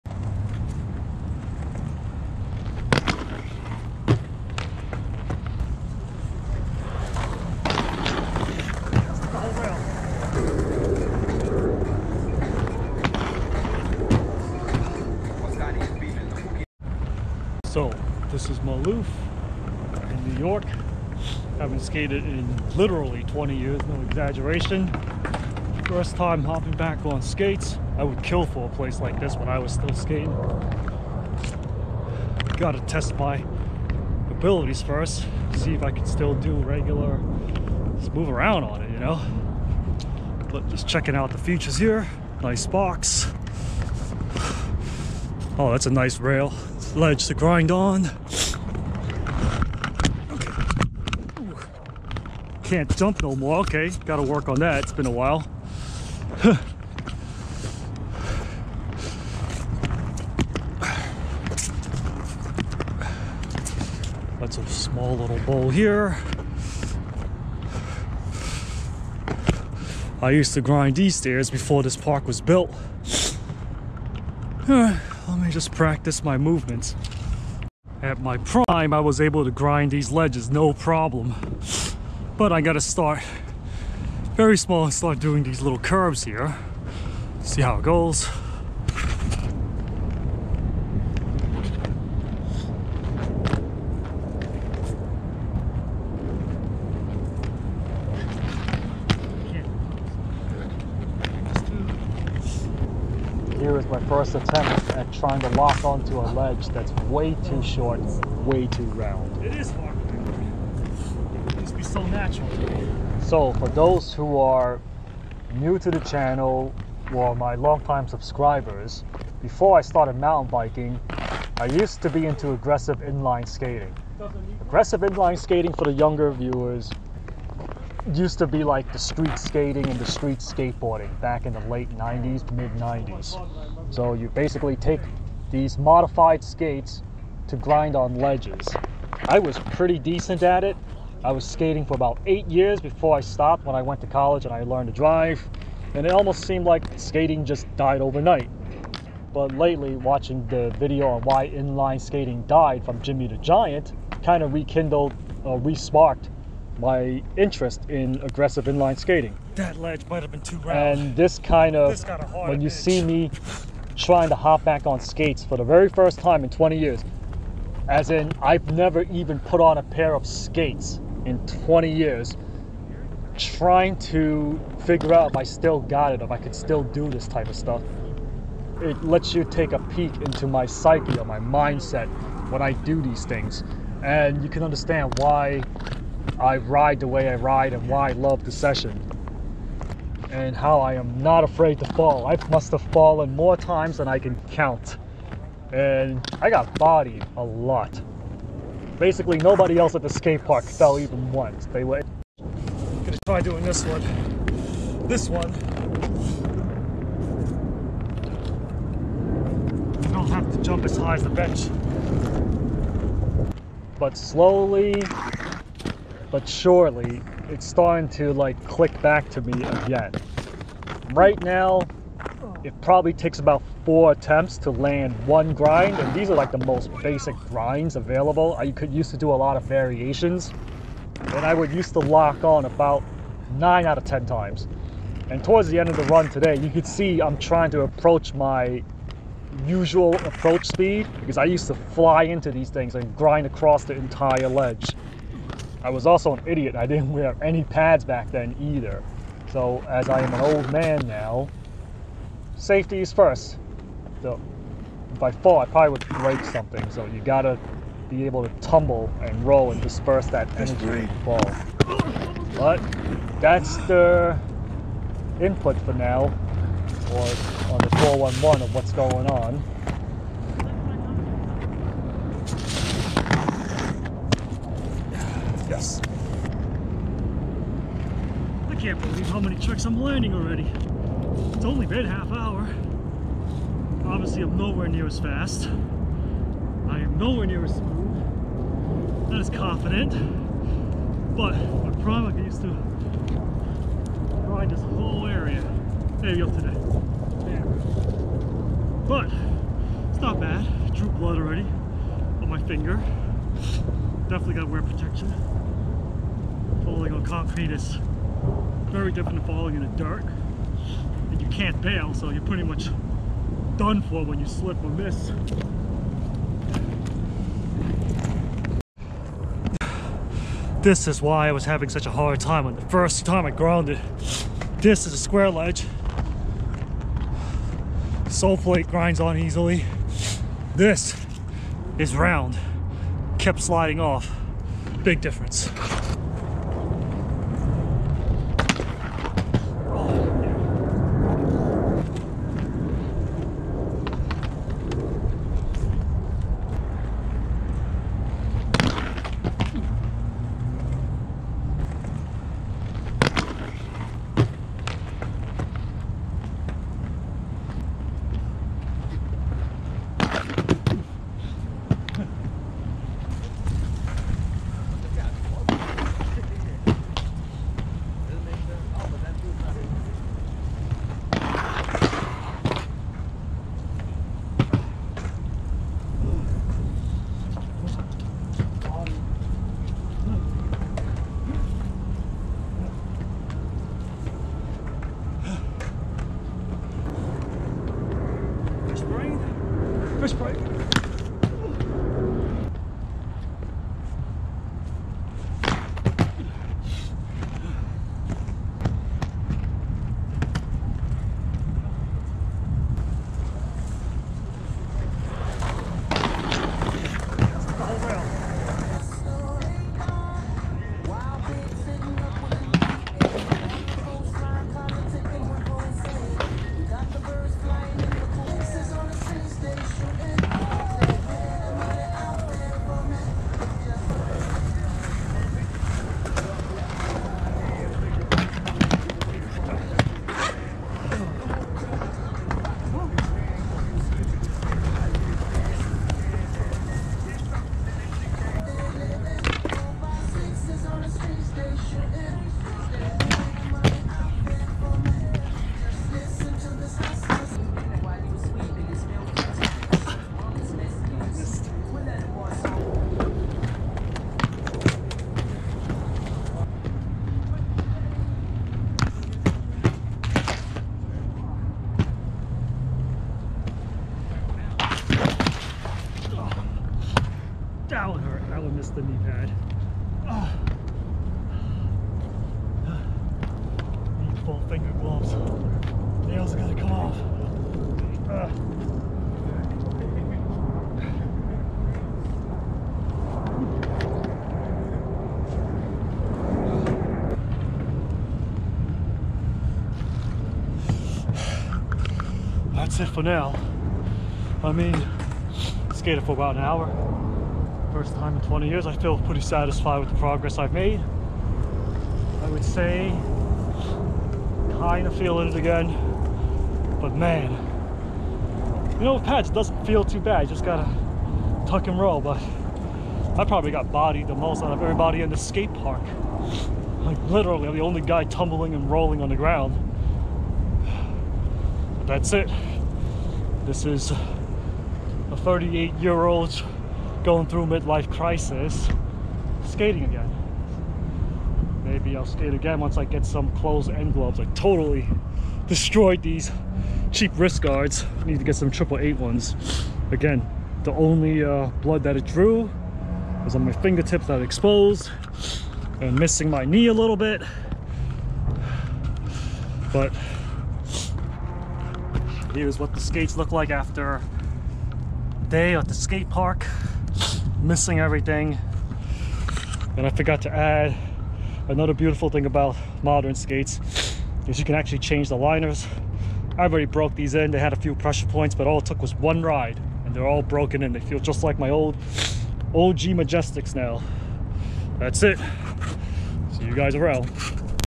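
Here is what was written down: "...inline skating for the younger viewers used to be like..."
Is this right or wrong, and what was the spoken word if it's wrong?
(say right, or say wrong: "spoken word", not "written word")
right.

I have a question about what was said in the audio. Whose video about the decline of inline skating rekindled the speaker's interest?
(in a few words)
Jimmy the Giant.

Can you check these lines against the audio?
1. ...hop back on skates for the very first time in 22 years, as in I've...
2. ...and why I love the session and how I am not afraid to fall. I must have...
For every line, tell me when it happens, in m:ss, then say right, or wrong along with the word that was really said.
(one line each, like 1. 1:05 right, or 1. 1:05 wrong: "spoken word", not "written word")
1. 2:44 wrong: "20", not "22"
2. 3:07 right.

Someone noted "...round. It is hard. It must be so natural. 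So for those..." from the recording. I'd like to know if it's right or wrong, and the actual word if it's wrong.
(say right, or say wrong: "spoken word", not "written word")
right.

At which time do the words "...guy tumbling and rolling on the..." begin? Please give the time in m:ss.
8:38.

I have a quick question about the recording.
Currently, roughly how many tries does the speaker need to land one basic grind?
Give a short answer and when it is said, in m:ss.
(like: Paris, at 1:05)
4, at 3:43.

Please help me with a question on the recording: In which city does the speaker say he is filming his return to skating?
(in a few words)
New York.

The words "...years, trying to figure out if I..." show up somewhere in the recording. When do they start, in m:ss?
2:51.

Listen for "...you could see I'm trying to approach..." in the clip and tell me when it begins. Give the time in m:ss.
3:56.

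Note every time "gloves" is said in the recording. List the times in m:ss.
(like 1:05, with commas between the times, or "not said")
7:55, 8:54.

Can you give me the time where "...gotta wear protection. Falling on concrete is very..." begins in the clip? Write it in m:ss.
5:04.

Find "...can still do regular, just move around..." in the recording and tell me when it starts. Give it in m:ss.
0:35.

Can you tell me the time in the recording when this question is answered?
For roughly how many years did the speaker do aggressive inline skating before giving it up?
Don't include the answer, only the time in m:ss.
2:22.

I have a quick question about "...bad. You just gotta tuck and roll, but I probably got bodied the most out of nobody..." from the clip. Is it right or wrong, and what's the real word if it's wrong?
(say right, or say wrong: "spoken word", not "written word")
wrong: "everybody", not "nobody".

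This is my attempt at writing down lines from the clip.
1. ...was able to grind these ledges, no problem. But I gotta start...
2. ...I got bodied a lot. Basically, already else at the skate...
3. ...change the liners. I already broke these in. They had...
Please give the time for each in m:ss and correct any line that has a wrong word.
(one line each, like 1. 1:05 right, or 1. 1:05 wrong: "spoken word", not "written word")
1. 1:18 right
2. 3:16 wrong: "nobody", not "already"
3. 9:24 right.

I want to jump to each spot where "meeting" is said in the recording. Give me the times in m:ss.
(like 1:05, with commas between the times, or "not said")
not said.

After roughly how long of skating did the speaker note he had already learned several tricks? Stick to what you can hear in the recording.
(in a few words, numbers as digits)
Half hour.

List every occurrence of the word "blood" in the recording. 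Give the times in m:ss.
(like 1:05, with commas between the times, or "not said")
5:01, 9:01.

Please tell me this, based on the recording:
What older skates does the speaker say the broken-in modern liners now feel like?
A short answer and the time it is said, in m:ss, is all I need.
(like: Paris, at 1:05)
OG Majestics, at 9:32.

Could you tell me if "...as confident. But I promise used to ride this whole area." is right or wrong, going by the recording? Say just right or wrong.
right.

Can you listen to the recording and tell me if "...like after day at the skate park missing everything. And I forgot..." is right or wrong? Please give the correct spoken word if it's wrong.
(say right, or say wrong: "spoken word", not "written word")
right.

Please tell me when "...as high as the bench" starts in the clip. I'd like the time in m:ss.
3:30.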